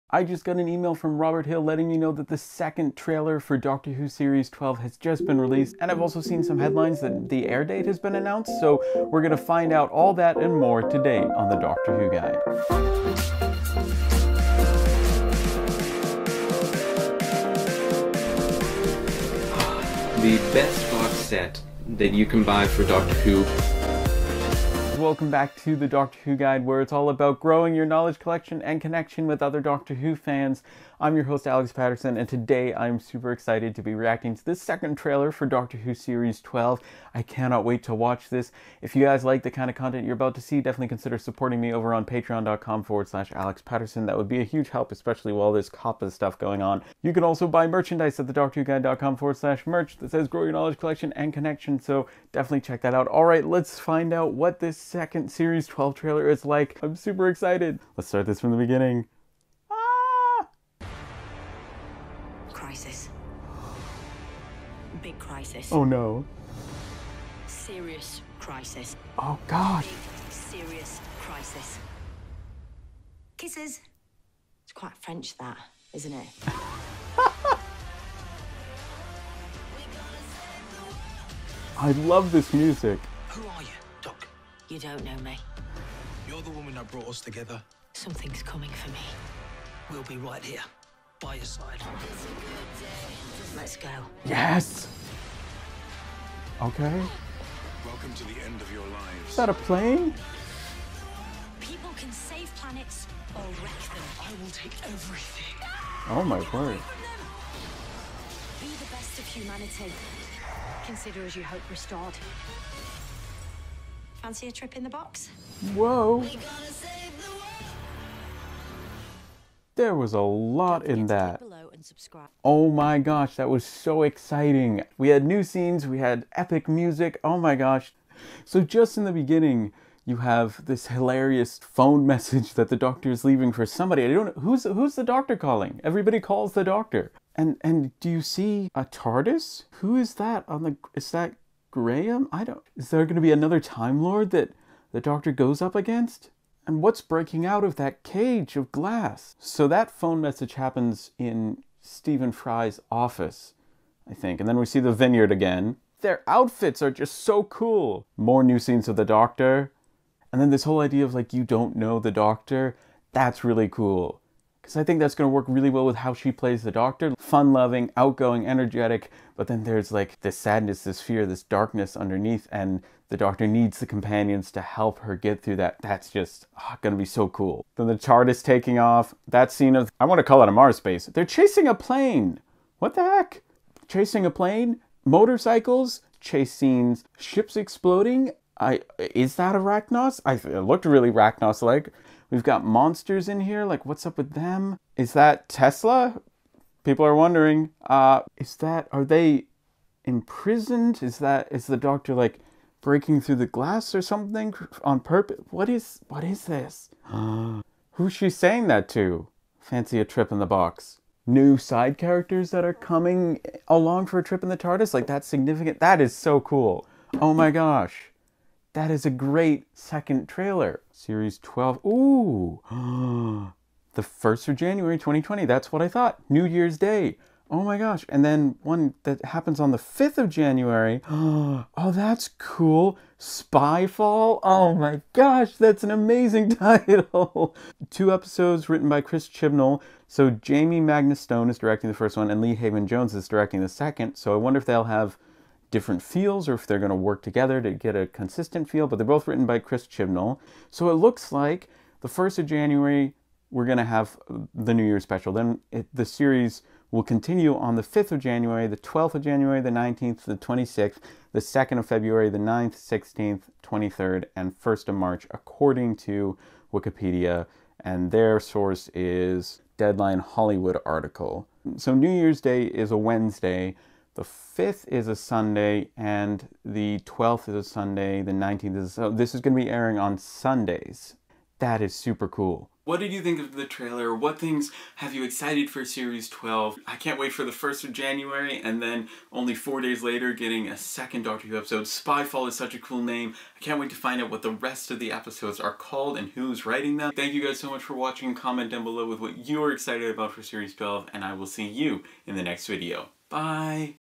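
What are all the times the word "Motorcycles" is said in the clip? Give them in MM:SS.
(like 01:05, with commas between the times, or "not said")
03:05.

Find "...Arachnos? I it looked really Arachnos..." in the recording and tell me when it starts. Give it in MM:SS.
03:09.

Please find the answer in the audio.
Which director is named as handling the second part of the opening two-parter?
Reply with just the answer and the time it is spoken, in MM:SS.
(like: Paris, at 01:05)
Lee Haven Jones, at 04:02.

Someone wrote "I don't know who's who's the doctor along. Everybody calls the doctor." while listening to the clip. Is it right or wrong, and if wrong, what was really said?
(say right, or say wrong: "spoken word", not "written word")
wrong: "calling", not "along".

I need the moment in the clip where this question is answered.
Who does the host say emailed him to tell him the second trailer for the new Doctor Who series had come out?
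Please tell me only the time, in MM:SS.
00:01.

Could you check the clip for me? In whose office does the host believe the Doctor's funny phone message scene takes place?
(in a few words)
Stephen Fry.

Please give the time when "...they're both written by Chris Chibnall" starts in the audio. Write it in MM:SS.
04:08.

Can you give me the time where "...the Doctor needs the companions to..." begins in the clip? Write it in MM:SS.
02:53.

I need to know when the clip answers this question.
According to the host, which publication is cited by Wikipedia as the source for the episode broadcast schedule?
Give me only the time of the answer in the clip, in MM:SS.
04:29.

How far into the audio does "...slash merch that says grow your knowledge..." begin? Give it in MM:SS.
00:49.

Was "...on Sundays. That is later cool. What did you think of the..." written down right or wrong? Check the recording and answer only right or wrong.
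wrong.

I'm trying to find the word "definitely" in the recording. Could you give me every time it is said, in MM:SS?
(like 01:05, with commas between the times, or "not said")
00:40, 00:52.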